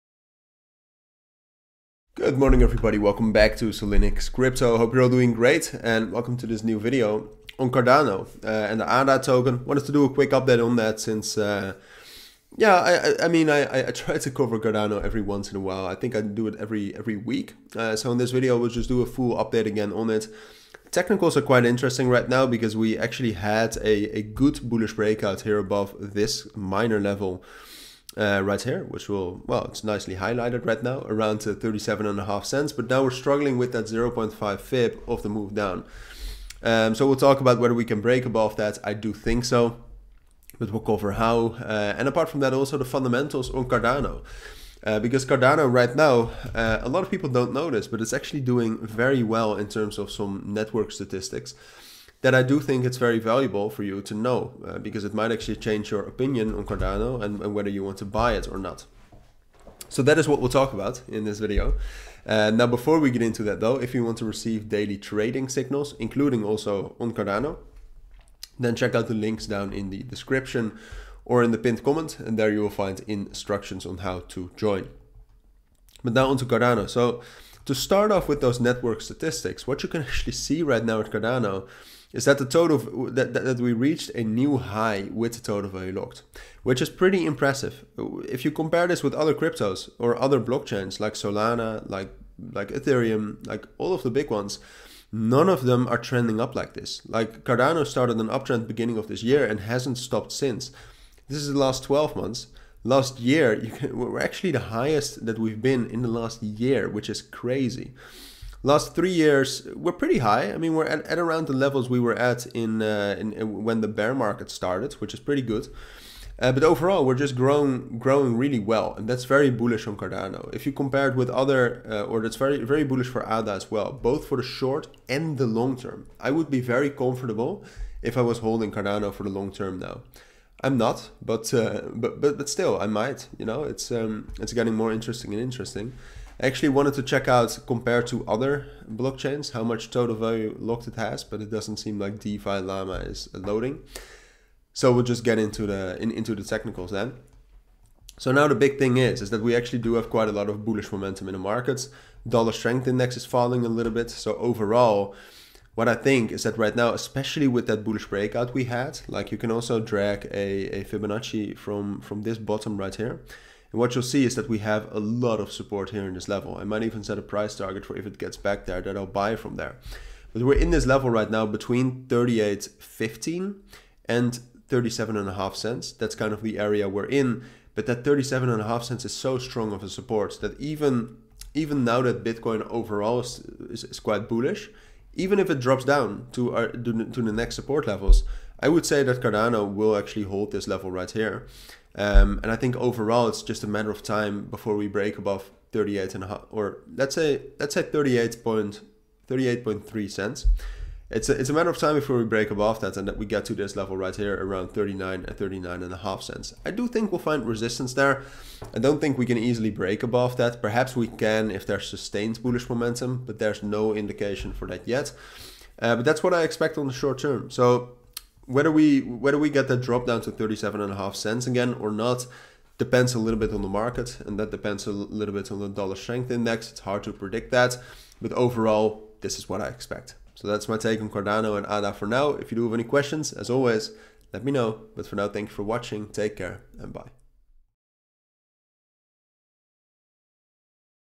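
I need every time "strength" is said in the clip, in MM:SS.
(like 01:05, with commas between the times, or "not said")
02:32, 03:45.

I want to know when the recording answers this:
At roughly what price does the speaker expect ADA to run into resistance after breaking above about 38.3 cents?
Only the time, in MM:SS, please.
03:25.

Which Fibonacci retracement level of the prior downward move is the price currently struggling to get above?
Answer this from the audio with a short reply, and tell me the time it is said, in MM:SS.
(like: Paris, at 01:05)
0.5, at 00:33.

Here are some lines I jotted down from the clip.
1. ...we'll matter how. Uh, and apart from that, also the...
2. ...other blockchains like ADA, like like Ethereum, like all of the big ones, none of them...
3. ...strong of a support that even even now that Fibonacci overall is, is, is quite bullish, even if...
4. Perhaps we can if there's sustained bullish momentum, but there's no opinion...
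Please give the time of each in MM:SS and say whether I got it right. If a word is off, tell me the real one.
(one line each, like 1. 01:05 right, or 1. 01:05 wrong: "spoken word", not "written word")
1. 00:40 wrong: "cover", not "matter"
2. 01:30 wrong: "Solana", not "ADA"
3. 02:59 wrong: "Bitcoin", not "Fibonacci"
4. 03:30 wrong: "indication", not "opinion".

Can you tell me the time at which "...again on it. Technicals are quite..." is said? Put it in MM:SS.
00:19.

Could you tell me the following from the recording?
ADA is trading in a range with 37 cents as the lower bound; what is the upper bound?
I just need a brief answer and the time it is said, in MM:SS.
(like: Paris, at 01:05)
38.15 cents, at 02:52.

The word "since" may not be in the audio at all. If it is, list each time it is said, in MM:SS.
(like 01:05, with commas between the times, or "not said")
00:10, 01:40.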